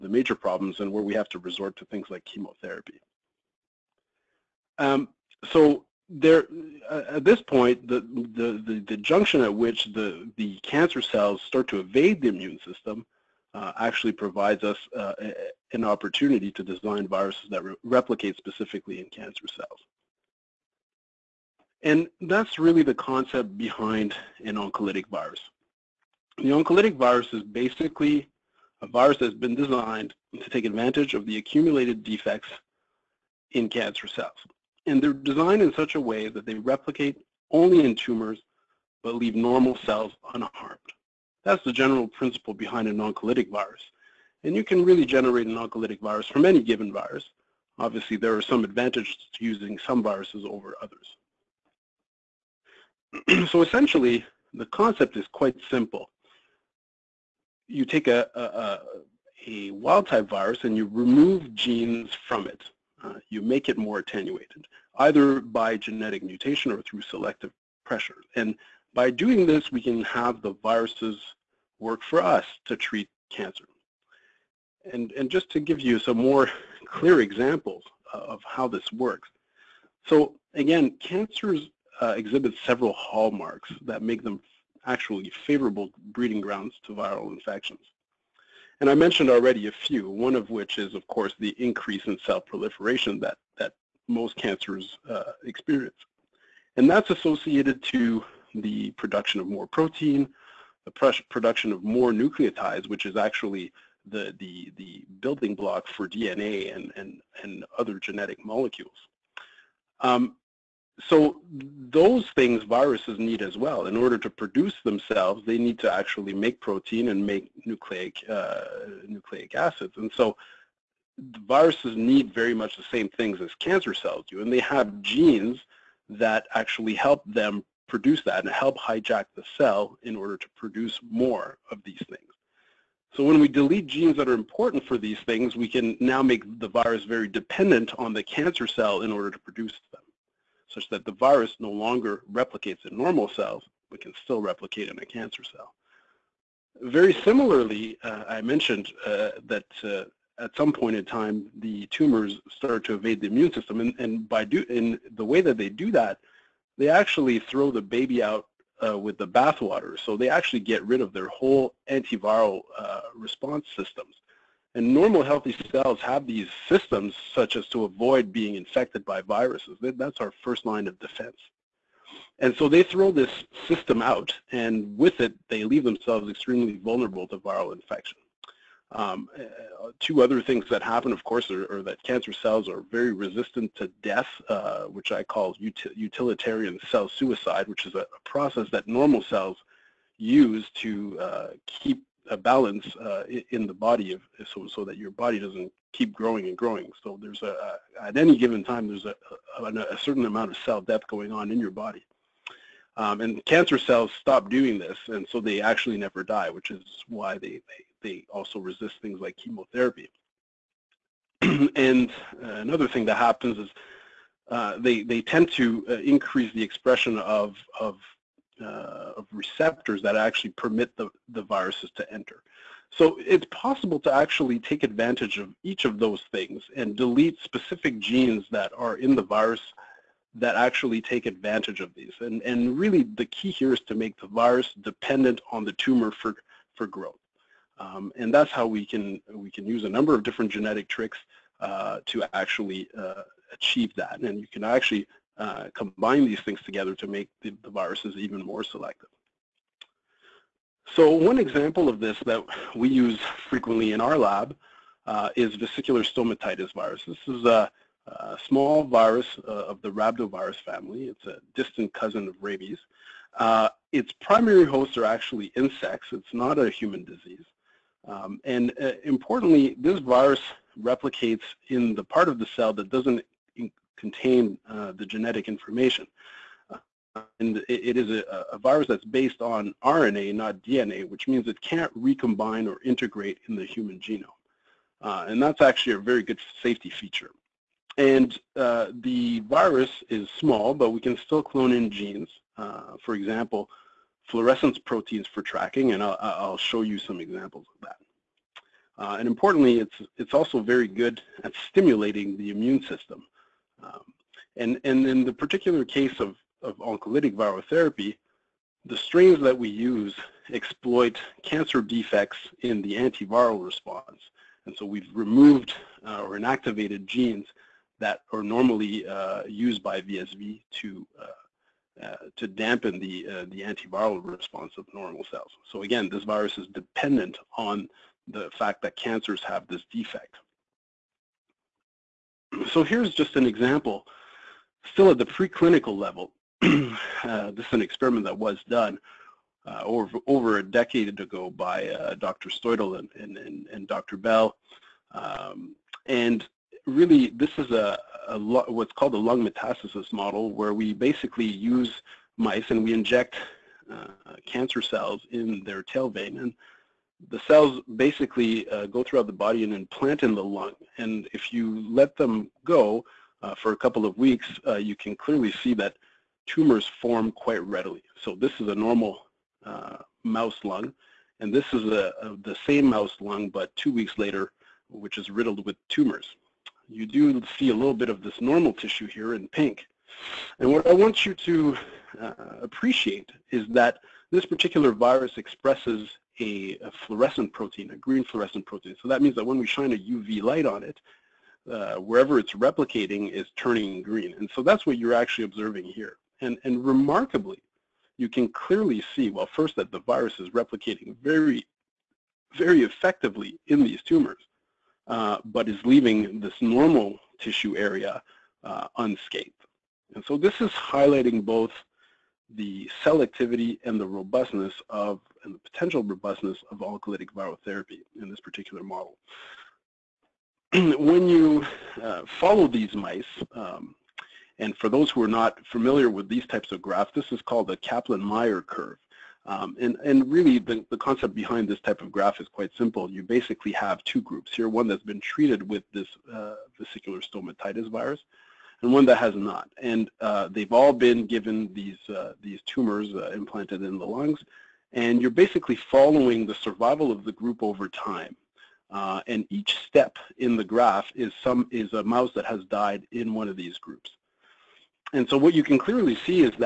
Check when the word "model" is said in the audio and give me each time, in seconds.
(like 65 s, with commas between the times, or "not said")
350 s, 418 s.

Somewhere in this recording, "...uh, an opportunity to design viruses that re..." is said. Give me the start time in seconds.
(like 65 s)
14 s.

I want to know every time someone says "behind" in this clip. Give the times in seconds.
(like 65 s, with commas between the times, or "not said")
23 s, 42 s, 431 s.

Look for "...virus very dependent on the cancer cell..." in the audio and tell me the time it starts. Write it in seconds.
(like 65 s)
136 s.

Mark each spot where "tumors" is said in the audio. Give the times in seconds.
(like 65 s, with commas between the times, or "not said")
37 s, 151 s, 235 s, 366 s, 375 s, 404 s, 442 s.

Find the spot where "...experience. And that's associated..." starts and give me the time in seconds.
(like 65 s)
95 s.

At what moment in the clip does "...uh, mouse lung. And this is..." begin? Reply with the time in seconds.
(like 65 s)
369 s.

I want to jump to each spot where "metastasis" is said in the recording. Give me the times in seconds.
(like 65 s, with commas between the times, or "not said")
349 s.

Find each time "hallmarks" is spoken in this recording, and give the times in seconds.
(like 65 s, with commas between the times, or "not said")
82 s.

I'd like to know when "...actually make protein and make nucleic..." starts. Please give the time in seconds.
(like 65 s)
115 s.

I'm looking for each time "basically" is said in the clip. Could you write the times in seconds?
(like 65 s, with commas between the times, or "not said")
27 s, 350 s, 357 s, 433 s, 445 s.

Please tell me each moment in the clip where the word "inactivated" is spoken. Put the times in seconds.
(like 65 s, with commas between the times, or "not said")
316 s.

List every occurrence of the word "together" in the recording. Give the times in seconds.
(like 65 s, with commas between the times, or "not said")
246 s.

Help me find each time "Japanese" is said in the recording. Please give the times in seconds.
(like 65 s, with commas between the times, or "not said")
not said.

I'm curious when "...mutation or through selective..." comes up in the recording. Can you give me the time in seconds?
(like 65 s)
66 s.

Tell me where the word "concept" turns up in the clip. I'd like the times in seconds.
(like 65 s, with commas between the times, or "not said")
22 s, 54 s, 430 s.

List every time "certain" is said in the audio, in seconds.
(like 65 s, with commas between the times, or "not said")
199 s.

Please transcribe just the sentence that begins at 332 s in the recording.
So here's just an example, still at the preclinical level.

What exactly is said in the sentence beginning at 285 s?
Uh, and that's actually a very good safety feature.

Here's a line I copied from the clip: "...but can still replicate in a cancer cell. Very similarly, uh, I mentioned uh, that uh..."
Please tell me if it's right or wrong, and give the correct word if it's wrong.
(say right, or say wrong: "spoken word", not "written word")
right.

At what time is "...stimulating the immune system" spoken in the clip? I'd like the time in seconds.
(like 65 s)
301 s.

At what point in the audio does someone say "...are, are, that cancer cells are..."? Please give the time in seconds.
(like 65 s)
181 s.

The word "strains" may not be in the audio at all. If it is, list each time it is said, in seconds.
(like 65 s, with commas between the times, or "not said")
308 s.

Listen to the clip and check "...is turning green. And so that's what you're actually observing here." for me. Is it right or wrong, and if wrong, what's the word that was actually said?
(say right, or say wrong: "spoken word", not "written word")
right.